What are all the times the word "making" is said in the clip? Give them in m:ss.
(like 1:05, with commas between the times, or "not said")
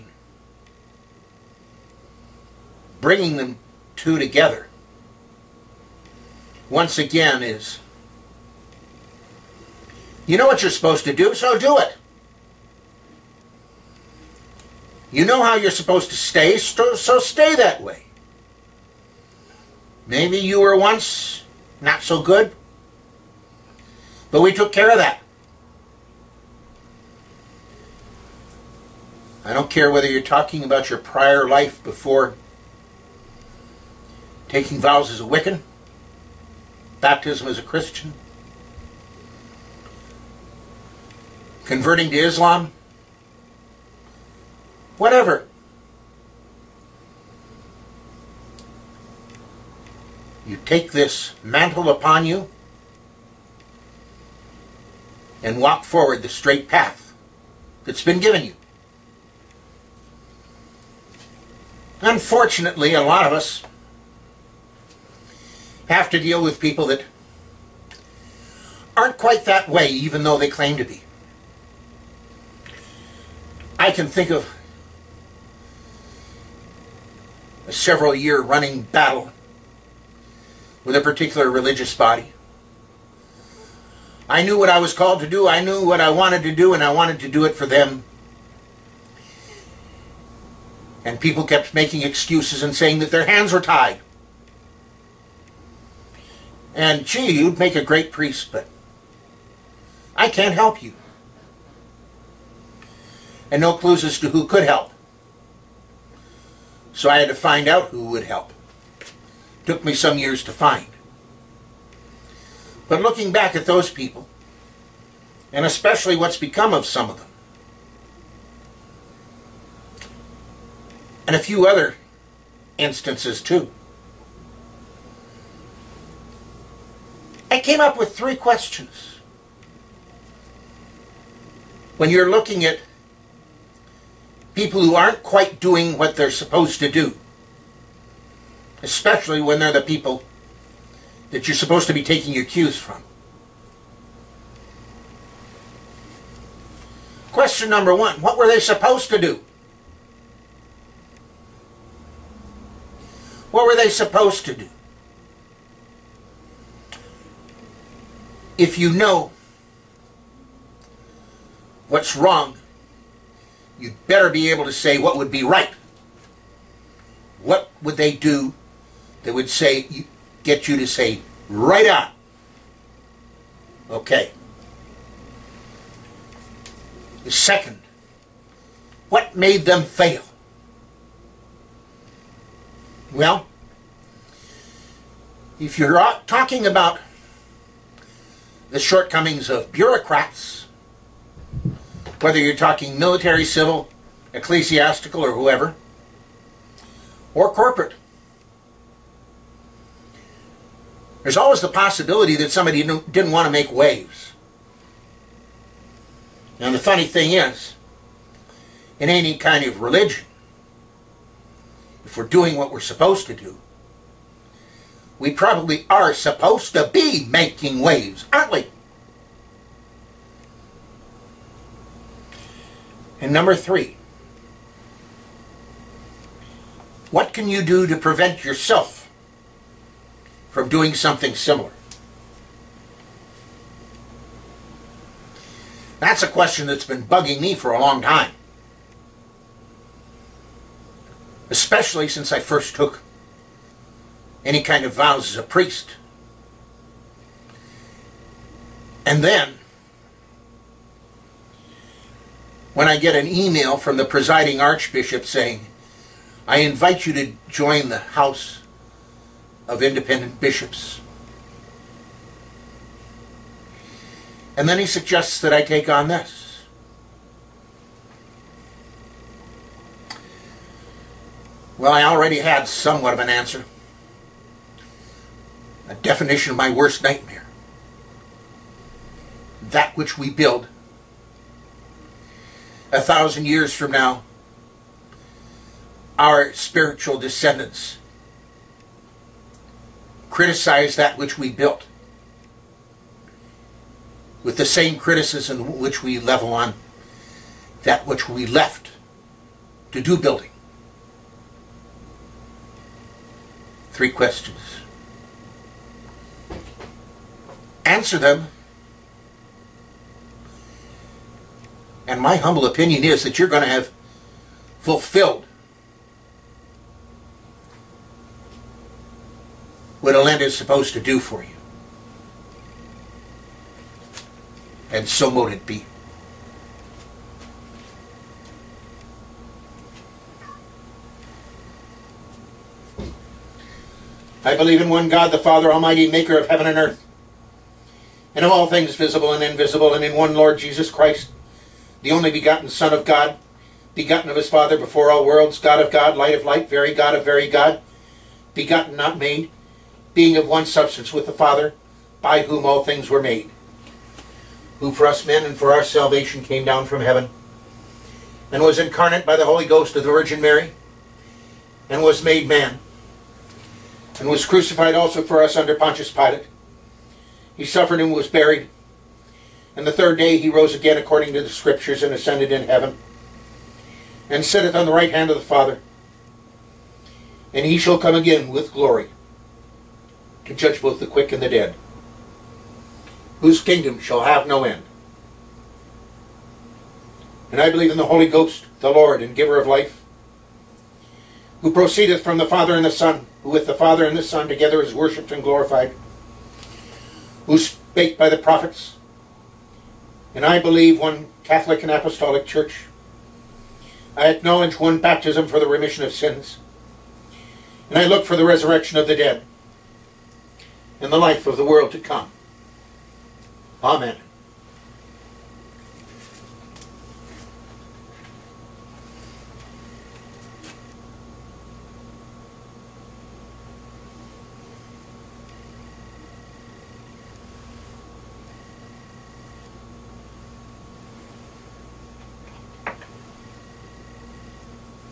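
1:31, 3:37.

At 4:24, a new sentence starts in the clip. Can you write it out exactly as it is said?
And then he suggests that I take on this.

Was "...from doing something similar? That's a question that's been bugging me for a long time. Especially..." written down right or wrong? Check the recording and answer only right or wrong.
right.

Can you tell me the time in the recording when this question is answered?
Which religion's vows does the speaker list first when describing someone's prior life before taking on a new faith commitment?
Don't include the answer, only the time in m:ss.
0:35.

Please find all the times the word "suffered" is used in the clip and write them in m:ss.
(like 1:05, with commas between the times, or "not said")
6:07.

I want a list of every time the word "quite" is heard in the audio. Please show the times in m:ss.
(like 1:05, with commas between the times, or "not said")
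1:09, 2:15.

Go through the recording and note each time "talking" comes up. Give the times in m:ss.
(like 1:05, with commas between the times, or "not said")
0:30, 3:06, 3:12.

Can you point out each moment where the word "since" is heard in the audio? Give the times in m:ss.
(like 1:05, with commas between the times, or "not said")
4:02.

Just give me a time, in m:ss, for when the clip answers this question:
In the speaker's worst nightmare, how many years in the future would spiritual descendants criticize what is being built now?
4:42.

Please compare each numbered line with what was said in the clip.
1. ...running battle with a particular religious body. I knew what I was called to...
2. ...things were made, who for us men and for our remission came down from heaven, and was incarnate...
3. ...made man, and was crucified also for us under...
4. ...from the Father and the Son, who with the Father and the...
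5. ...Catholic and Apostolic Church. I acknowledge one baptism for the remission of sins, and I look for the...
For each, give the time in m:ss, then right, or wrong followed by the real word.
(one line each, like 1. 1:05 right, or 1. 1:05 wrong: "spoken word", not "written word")
1. 1:18 right
2. 5:52 wrong: "salvation", not "remission"
3. 6:02 right
4. 6:32 right
5. 6:41 right.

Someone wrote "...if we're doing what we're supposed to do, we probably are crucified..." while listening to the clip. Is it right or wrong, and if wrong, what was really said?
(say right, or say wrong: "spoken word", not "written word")
wrong: "supposed", not "crucified".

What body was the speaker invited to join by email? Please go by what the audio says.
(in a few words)
House of Independent Bishops.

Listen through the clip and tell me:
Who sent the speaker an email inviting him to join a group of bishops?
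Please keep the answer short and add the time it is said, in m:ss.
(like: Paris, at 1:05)
the presiding archbishop, at 4:14.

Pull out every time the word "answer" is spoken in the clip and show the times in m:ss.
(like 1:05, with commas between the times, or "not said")
4:33, 5:07.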